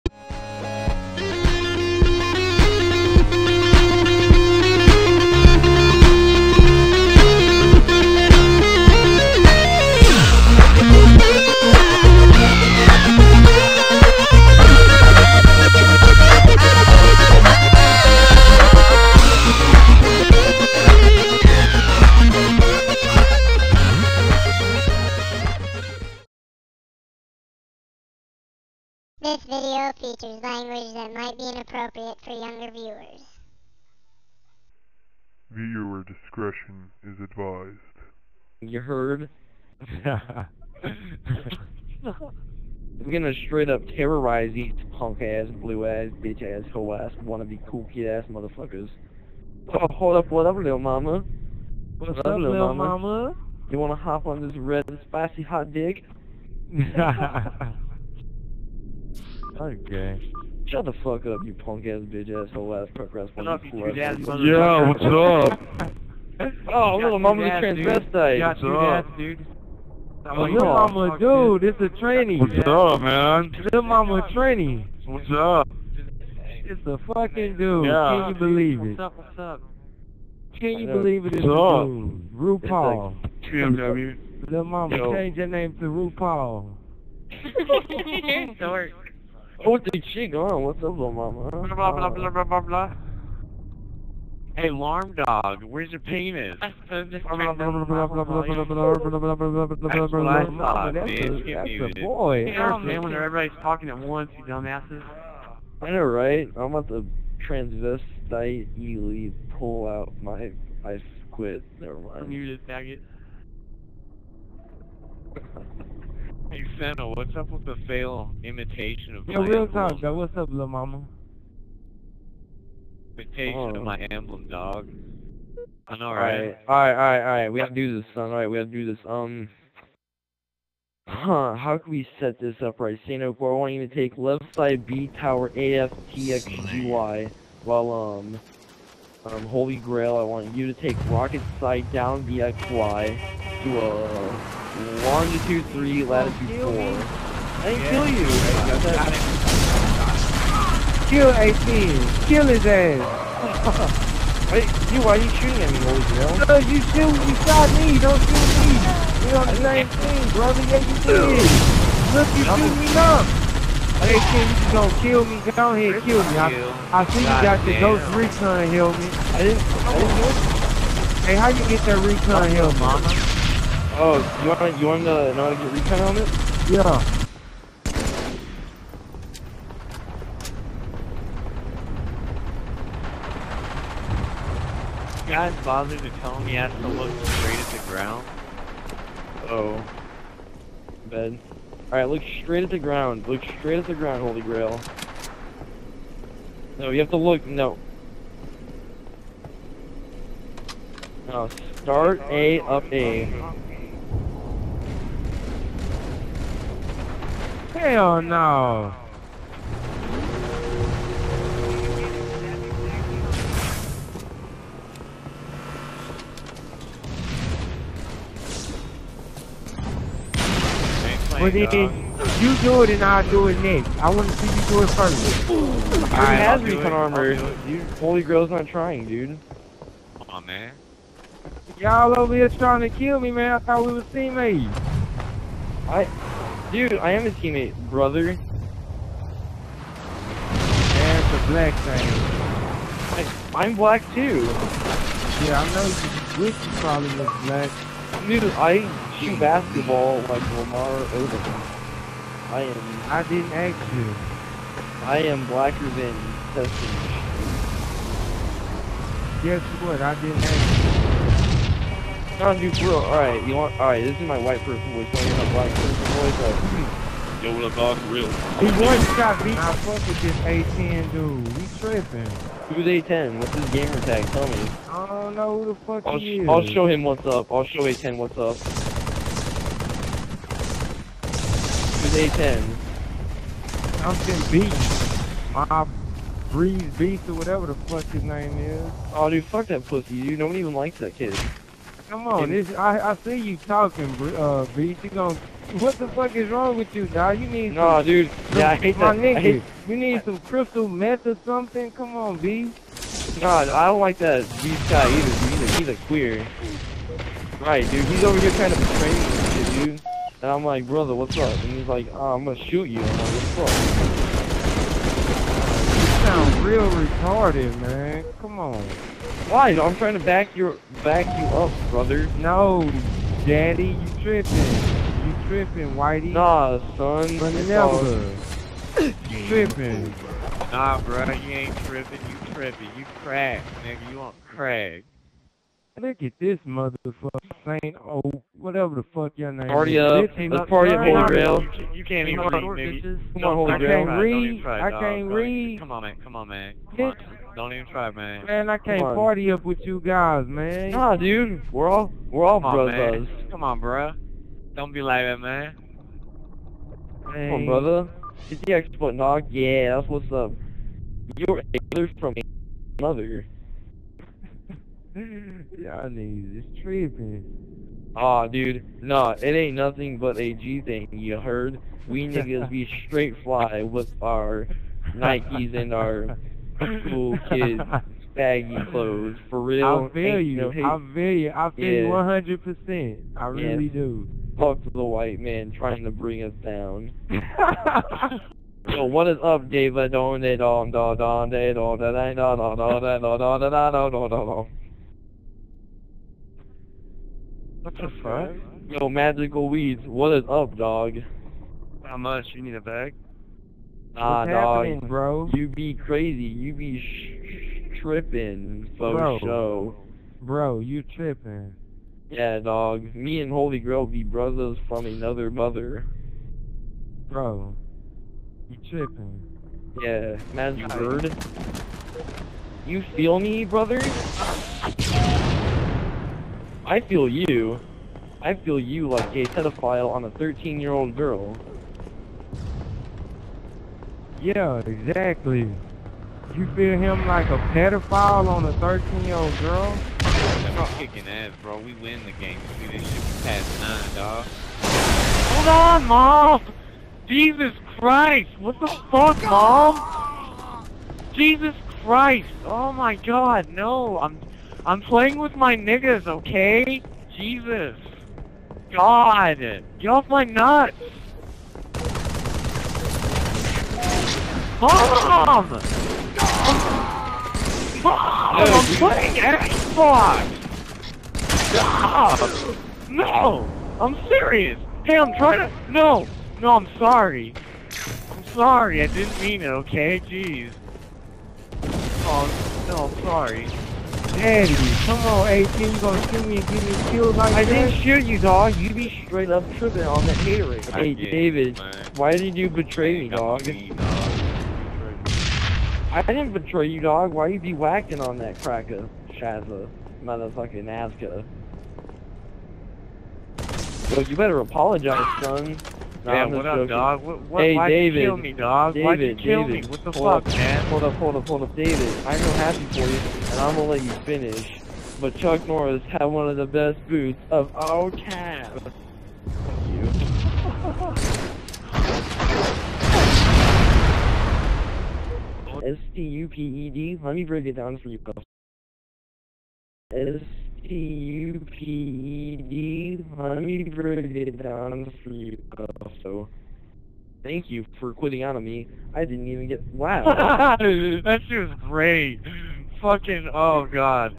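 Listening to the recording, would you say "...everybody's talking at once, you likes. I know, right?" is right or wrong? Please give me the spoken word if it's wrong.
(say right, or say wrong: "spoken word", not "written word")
wrong: "dumbasses", not "likes".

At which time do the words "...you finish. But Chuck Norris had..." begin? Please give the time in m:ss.
8:34.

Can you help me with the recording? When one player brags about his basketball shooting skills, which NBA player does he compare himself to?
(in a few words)
Lamar Odom.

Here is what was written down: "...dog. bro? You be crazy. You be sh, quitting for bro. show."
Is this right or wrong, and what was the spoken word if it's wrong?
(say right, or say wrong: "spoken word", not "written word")
wrong: "tripping", not "quitting".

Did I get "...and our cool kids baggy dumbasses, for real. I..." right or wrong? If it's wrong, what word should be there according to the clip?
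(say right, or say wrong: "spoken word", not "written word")
wrong: "clothes", not "dumbasses".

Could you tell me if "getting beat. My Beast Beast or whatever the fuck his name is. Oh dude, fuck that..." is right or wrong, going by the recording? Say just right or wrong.
wrong.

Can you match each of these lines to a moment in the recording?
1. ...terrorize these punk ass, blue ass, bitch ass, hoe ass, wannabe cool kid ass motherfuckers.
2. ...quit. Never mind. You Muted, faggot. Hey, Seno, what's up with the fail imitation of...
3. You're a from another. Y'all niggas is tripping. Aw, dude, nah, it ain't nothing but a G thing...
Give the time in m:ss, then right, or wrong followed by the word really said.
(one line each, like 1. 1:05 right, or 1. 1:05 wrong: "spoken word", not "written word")
1. 0:43 right
2. 1:51 right
3. 6:01 right.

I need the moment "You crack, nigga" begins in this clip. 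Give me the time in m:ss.
5:32.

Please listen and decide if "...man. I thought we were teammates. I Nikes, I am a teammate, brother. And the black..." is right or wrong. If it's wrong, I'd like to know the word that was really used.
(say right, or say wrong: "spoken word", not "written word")
wrong: "Dude", not "Nikes".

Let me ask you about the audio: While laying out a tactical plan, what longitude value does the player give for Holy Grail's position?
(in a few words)
3.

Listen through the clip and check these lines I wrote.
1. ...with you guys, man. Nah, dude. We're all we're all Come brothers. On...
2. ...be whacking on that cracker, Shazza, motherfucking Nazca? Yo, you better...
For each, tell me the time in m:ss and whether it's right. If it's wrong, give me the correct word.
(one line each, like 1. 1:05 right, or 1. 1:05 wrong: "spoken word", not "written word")
1. 5:49 right
2. 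8:17 right.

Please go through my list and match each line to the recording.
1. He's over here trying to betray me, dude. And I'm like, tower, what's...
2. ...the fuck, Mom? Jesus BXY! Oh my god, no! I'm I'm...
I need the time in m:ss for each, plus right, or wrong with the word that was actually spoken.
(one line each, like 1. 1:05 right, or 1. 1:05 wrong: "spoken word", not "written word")
1. 5:08 wrong: "brother", not "tower"
2. 7:28 wrong: "Christ", not "BXY".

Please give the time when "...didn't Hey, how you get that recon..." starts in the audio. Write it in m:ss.
2:49.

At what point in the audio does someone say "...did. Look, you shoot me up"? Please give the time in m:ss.
2:41.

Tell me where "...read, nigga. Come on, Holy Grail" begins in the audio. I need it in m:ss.
5:42.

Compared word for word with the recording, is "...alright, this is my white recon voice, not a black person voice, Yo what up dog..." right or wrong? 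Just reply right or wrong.
wrong.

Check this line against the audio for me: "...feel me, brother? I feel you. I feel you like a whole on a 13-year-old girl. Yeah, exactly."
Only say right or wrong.
wrong.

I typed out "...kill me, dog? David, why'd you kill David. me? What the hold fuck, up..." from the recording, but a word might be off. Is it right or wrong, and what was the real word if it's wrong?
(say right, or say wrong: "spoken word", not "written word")
right.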